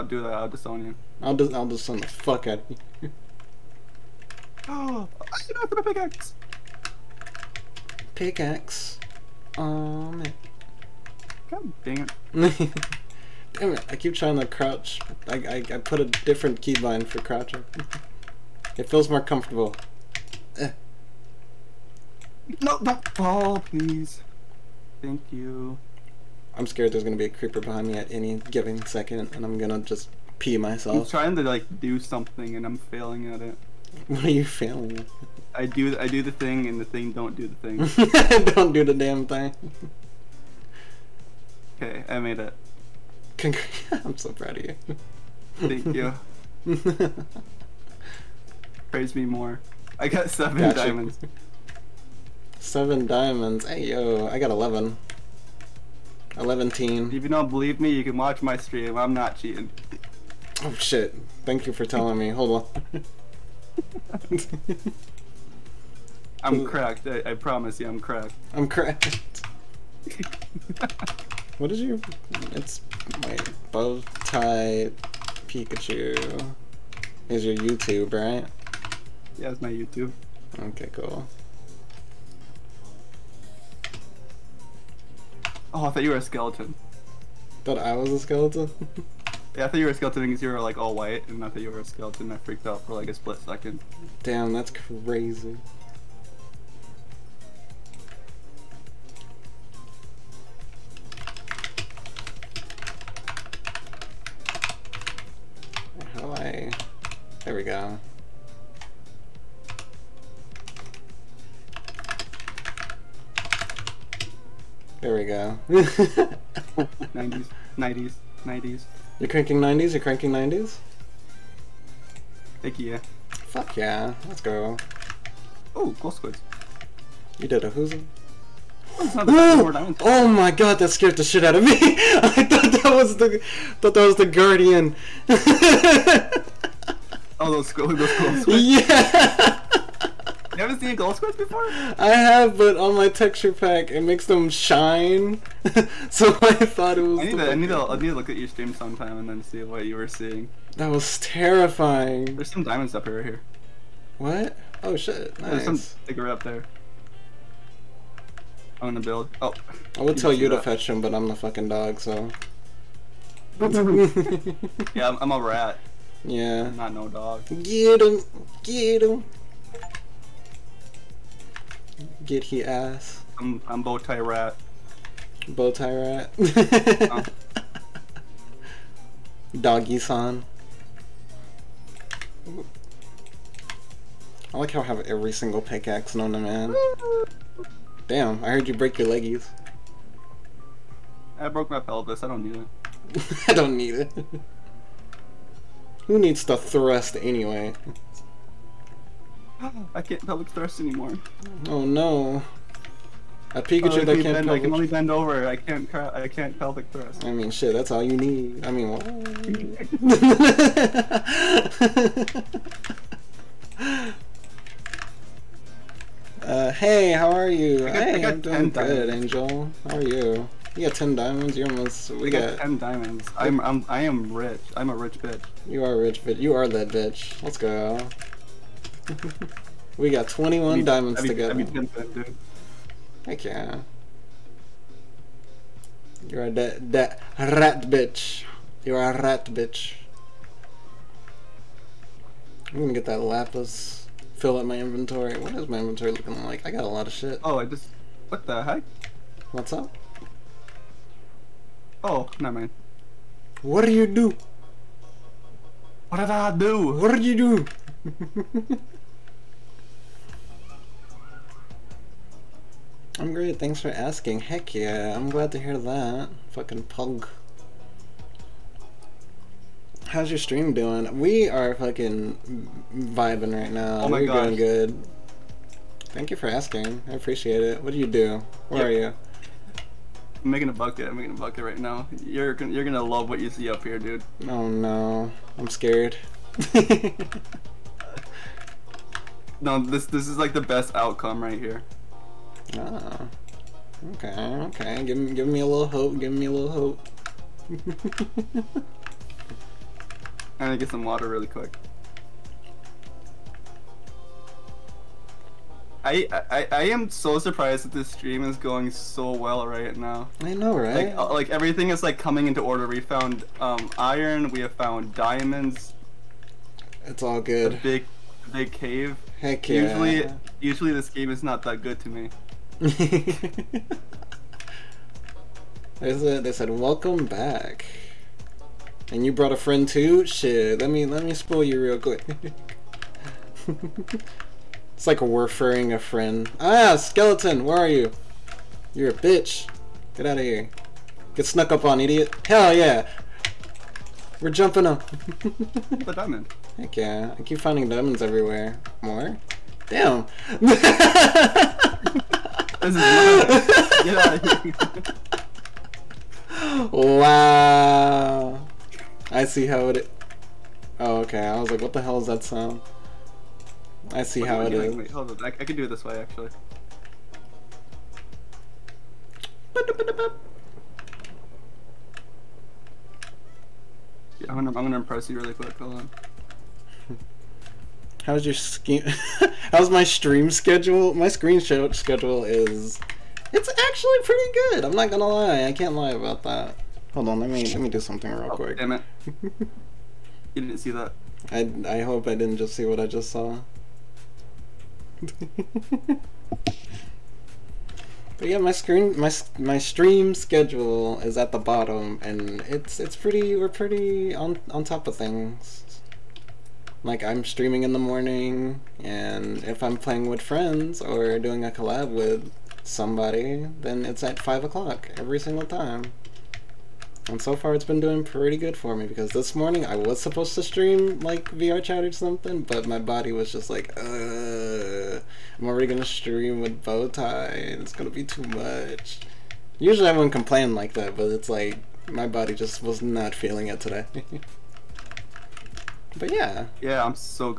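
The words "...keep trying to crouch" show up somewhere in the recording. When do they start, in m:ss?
0:13.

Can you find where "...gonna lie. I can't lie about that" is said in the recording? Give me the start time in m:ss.
6:25.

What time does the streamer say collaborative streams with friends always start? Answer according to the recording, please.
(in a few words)
5 o'clock.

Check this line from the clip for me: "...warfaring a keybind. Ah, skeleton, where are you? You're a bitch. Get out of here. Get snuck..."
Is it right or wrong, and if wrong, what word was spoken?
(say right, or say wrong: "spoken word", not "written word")
wrong: "friend", not "keybind".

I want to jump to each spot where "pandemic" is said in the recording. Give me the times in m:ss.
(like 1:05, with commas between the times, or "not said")
not said.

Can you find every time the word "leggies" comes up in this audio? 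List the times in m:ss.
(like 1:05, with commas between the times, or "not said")
3:09.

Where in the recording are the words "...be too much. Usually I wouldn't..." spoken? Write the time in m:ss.
7:08.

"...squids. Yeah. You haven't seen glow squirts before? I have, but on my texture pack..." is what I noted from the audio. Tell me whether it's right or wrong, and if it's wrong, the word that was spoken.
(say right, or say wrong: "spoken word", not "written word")
right.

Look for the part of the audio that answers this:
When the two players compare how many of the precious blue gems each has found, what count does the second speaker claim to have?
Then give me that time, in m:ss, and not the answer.
0:54.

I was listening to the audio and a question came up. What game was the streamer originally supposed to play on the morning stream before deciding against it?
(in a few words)
VR Chat.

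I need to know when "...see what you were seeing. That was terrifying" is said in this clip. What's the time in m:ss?
2:29.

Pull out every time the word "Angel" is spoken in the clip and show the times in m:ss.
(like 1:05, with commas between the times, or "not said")
3:39.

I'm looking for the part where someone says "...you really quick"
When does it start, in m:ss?
6:15.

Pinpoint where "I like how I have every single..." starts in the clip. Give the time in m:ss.
3:04.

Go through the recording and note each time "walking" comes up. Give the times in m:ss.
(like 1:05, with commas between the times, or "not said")
not said.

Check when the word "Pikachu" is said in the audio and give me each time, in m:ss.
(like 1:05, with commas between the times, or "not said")
1:15, 3:23.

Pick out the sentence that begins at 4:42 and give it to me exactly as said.
You're you're gonna love what you see up here, dude.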